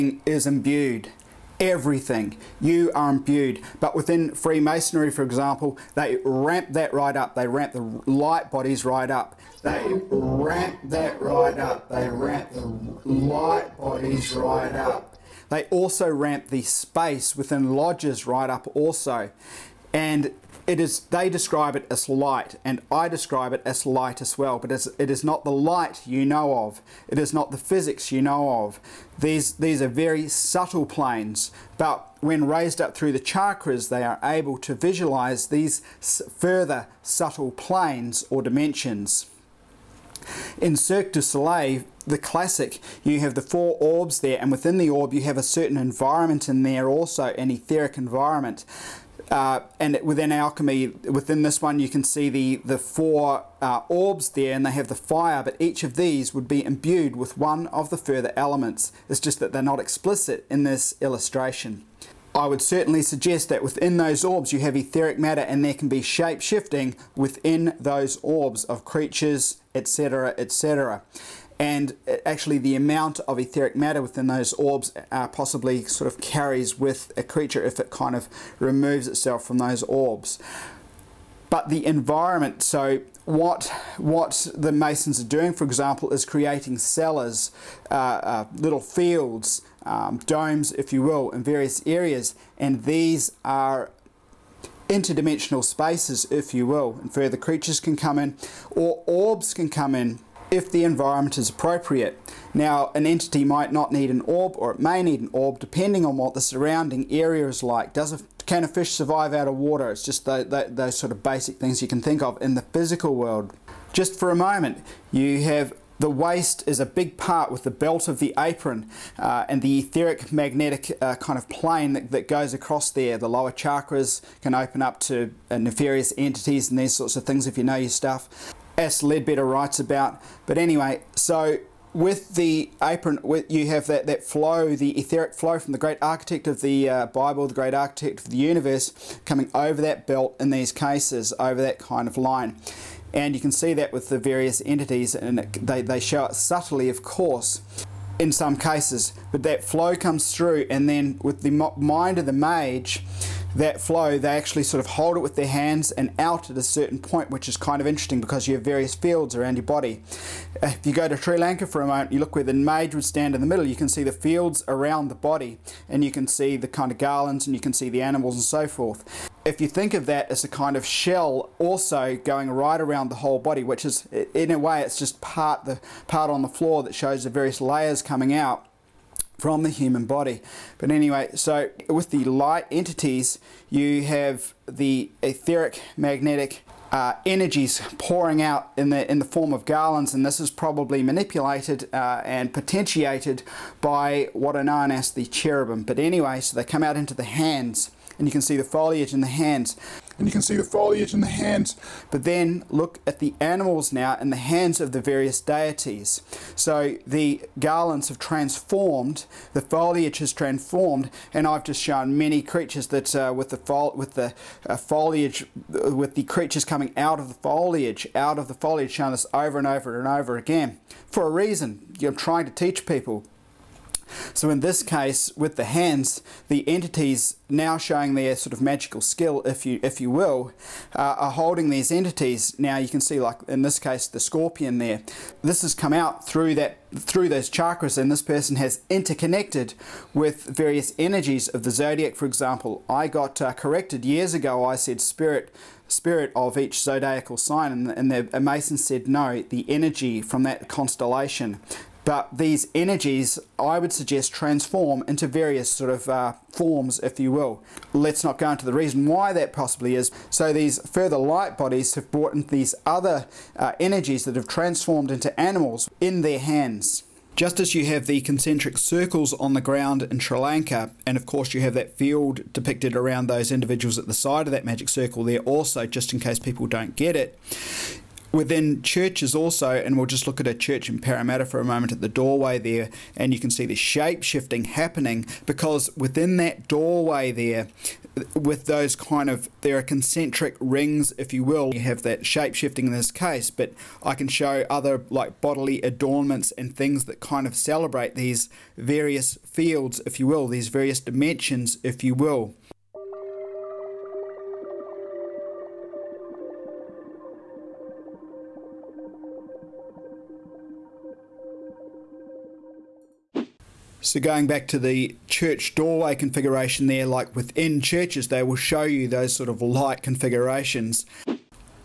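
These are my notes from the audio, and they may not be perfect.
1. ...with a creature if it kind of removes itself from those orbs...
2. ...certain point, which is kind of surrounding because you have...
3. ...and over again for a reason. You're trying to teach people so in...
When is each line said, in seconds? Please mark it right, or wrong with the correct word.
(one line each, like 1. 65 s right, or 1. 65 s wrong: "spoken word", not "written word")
1. 76 s right
2. 156 s wrong: "interesting", not "surrounding"
3. 220 s right.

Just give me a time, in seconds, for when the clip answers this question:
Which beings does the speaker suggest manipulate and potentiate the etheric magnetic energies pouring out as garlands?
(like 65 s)
195 s.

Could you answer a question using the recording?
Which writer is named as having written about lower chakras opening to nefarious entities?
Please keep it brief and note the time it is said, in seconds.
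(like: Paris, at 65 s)
Leadbeater, at 129 s.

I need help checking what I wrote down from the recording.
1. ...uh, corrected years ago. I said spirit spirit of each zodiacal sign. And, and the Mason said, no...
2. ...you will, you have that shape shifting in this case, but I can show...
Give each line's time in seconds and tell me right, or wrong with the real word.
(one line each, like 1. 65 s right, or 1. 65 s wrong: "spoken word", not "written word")
1. 243 s right
2. 291 s right.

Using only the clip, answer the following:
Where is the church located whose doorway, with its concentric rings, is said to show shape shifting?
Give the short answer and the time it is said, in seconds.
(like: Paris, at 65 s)
Parramatta, at 280 s.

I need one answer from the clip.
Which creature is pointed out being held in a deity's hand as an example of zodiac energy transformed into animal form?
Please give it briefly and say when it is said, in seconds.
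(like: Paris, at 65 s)
scorpion, at 234 s.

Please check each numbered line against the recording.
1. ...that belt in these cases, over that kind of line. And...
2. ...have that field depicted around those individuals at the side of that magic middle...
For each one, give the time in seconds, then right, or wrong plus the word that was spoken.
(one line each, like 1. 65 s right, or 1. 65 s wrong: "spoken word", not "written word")
1. 139 s right
2. 271 s wrong: "circle", not "middle".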